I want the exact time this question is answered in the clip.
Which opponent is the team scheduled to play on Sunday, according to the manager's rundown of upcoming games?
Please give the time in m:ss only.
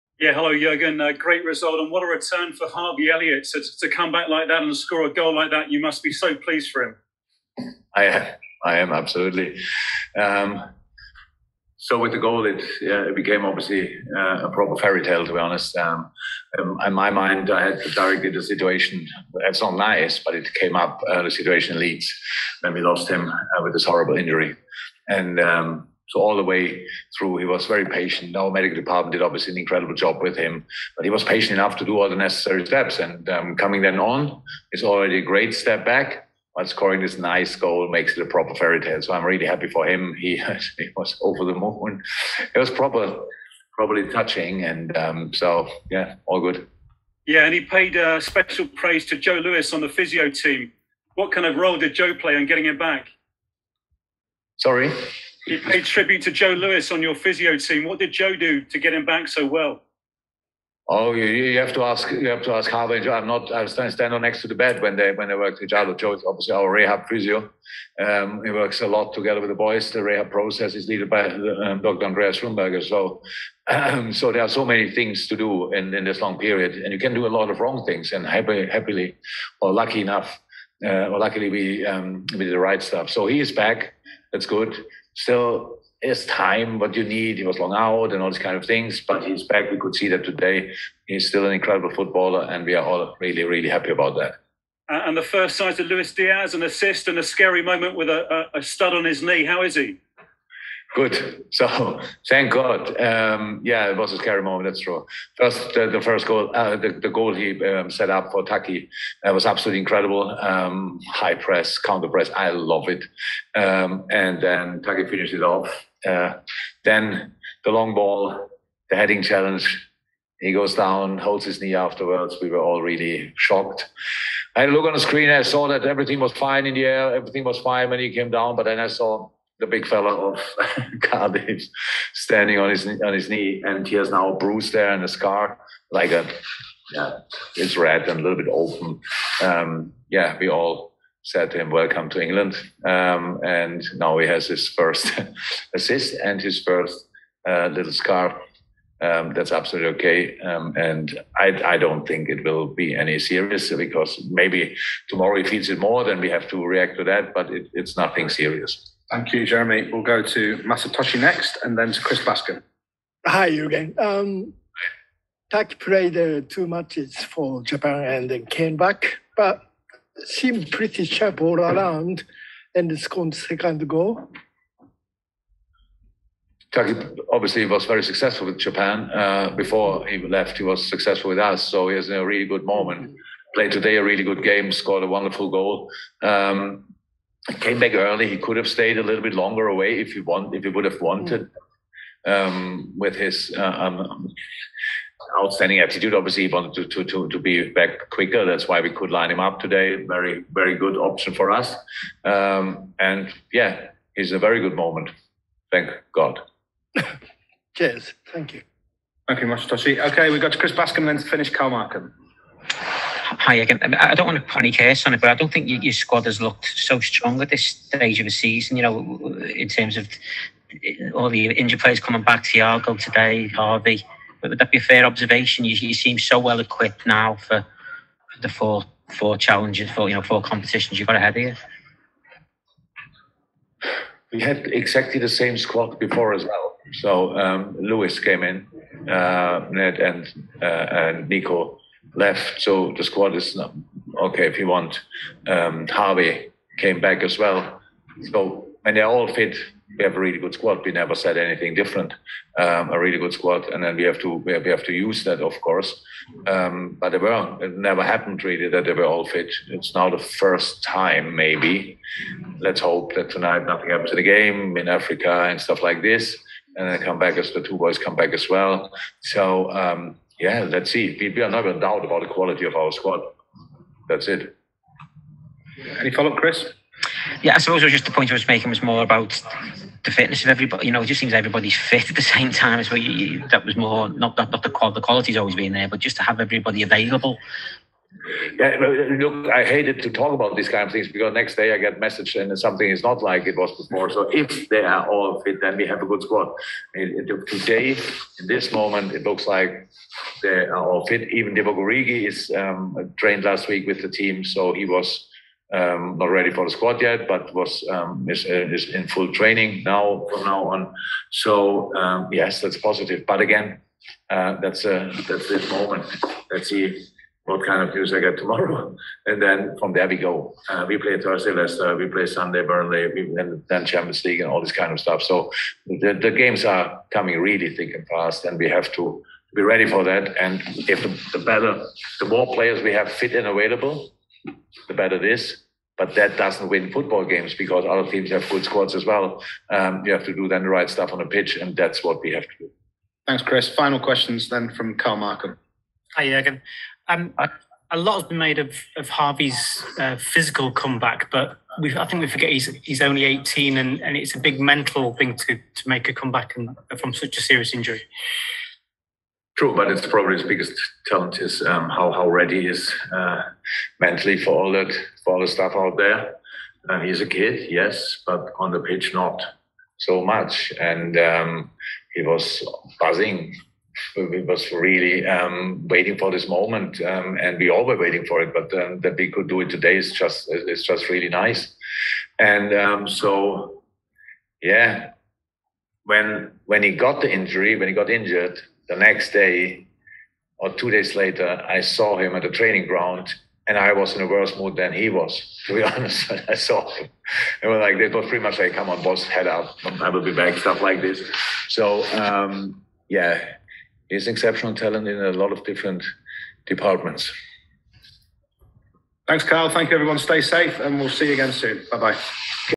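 5:22.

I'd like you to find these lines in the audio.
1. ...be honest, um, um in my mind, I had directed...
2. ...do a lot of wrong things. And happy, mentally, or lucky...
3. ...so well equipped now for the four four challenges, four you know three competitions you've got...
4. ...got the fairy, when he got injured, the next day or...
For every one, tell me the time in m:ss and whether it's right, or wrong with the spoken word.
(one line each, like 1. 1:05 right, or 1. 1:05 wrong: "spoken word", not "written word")
1. 0:15 right
2. 1:17 wrong: "happily", not "mentally"
3. 3:46 wrong: "four", not "three"
4. 6:26 wrong: "injury", not "fairy".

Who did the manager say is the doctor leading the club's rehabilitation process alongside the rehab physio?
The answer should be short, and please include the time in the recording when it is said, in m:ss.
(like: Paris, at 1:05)
Andreas Schlumberger, at 1:12.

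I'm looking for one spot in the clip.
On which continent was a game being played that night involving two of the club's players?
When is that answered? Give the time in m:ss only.
4:24.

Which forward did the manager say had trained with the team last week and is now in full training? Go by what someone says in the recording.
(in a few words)
Divock Origi.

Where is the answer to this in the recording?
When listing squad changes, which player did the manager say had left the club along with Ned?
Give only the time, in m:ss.
4:01.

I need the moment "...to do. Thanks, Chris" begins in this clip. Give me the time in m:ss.
5:42.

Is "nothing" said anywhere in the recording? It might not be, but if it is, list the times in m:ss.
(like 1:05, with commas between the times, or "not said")
2:37, 4:23.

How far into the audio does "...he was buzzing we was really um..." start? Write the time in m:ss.
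6:12.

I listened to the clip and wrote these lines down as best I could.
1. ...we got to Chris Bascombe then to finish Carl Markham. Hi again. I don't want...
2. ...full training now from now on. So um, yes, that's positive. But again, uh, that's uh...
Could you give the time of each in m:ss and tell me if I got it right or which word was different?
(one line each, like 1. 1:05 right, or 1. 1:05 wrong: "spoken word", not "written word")
1. 3:30 right
2. 5:09 right.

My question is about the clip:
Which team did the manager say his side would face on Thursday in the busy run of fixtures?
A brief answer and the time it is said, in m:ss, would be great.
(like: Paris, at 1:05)
Leicester, at 5:21.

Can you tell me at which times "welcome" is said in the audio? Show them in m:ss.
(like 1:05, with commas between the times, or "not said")
2:21.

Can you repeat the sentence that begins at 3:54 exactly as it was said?
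We had exactly the same squad before as well.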